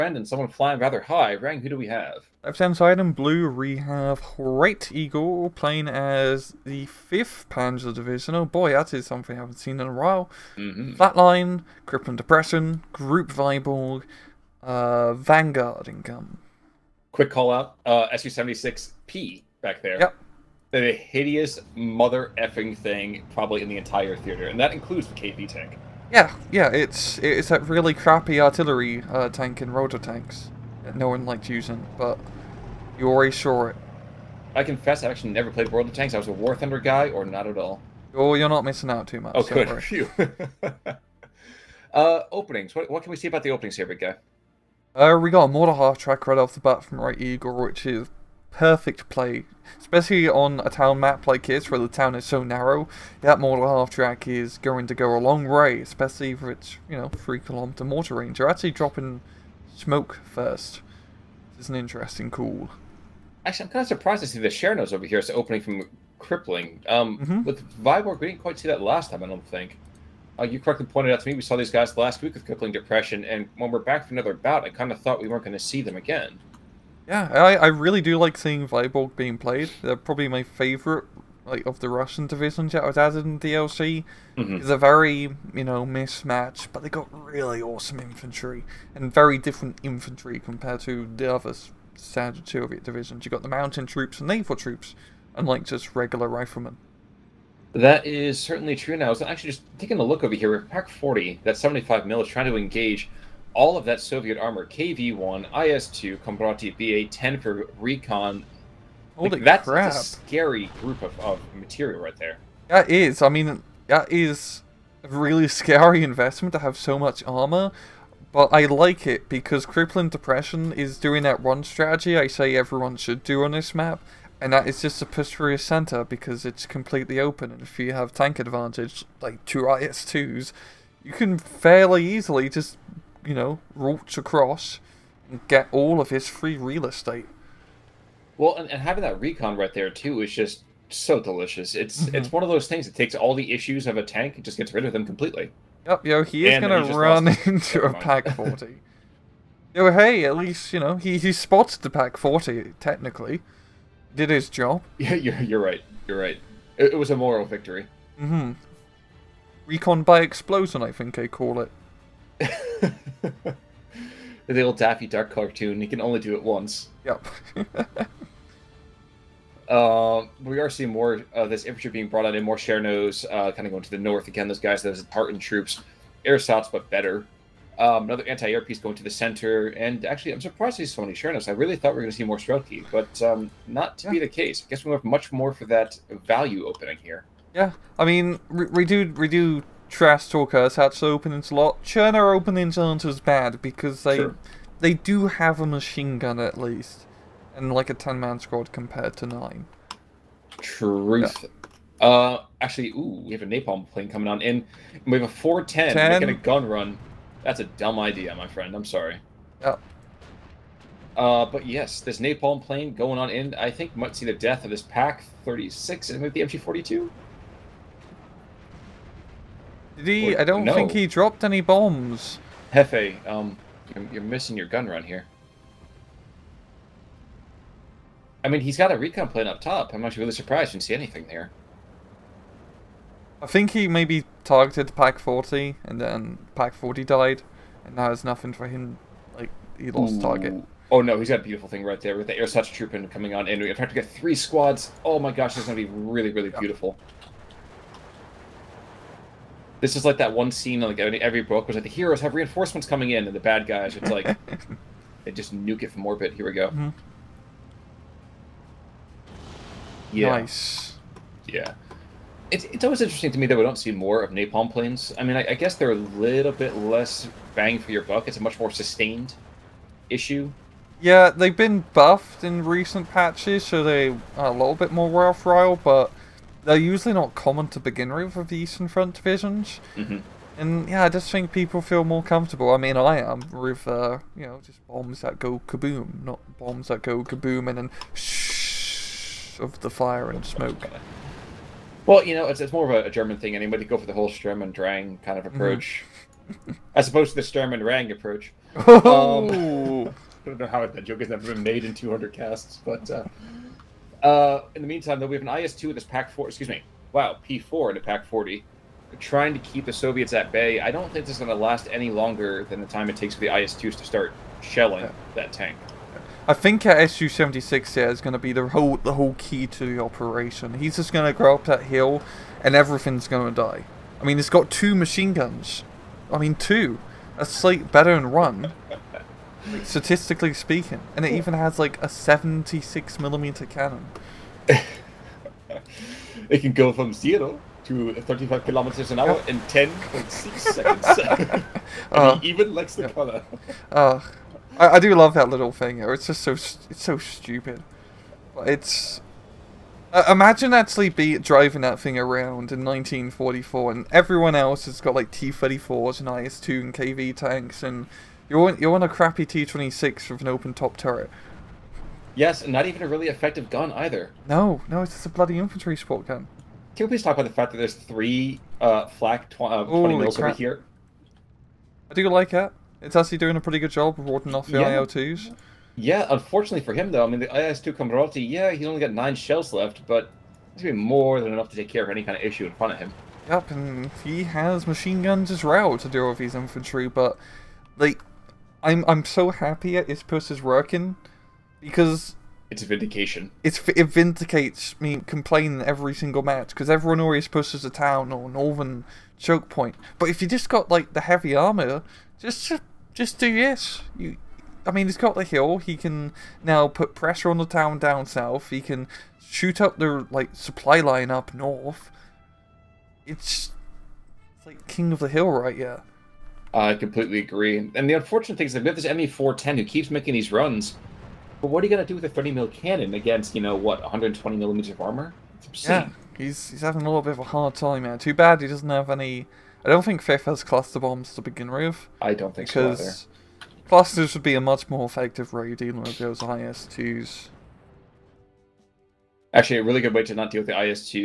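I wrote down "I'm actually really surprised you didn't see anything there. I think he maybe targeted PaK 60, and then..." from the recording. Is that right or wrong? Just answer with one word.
wrong.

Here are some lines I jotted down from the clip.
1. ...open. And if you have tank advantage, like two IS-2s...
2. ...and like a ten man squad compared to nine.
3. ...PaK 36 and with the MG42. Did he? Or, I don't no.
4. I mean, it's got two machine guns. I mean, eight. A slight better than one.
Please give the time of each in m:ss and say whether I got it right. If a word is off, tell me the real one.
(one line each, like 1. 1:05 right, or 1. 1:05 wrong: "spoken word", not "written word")
1. 2:07 right
2. 3:17 right
3. 3:34 right
4. 5:24 wrong: "two", not "eight".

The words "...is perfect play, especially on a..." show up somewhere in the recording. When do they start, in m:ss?
0:47.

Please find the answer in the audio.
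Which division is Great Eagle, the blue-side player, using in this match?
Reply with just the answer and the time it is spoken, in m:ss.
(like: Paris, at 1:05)
5th Panzer Division, at 0:06.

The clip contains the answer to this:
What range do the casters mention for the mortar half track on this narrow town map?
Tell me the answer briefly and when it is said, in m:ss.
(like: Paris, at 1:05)
3 kilometers, at 0:57.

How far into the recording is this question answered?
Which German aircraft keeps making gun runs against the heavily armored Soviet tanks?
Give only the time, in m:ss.
6:59.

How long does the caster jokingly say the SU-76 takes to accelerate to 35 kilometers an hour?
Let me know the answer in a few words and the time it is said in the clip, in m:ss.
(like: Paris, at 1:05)
10.6 seconds, at 5:39.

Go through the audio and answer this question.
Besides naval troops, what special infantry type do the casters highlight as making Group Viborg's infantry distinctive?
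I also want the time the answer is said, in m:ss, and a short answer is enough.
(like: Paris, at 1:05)
Mountain troops, at 1:33.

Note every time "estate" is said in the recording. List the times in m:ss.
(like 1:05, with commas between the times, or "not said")
2:16.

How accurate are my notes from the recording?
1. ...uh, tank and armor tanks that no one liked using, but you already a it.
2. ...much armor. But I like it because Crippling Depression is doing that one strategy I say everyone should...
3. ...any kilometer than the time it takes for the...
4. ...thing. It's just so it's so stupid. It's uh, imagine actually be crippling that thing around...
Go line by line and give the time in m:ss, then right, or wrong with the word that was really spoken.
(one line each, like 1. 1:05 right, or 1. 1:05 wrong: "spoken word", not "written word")
1. 0:29 wrong: "rotor", not "armor"
2. 1:56 right
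3. 5:11 wrong: "longer", not "kilometer"
4. 5:45 wrong: "driving", not "crippling".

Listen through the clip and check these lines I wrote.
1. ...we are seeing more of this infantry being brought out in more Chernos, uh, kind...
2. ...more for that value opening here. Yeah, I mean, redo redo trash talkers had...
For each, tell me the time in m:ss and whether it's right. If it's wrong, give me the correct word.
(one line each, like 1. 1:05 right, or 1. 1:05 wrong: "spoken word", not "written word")
1. 2:50 right
2. 3:05 right.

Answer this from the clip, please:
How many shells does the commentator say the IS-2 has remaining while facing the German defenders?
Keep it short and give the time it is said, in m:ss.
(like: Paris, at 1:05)
9, at 6:19.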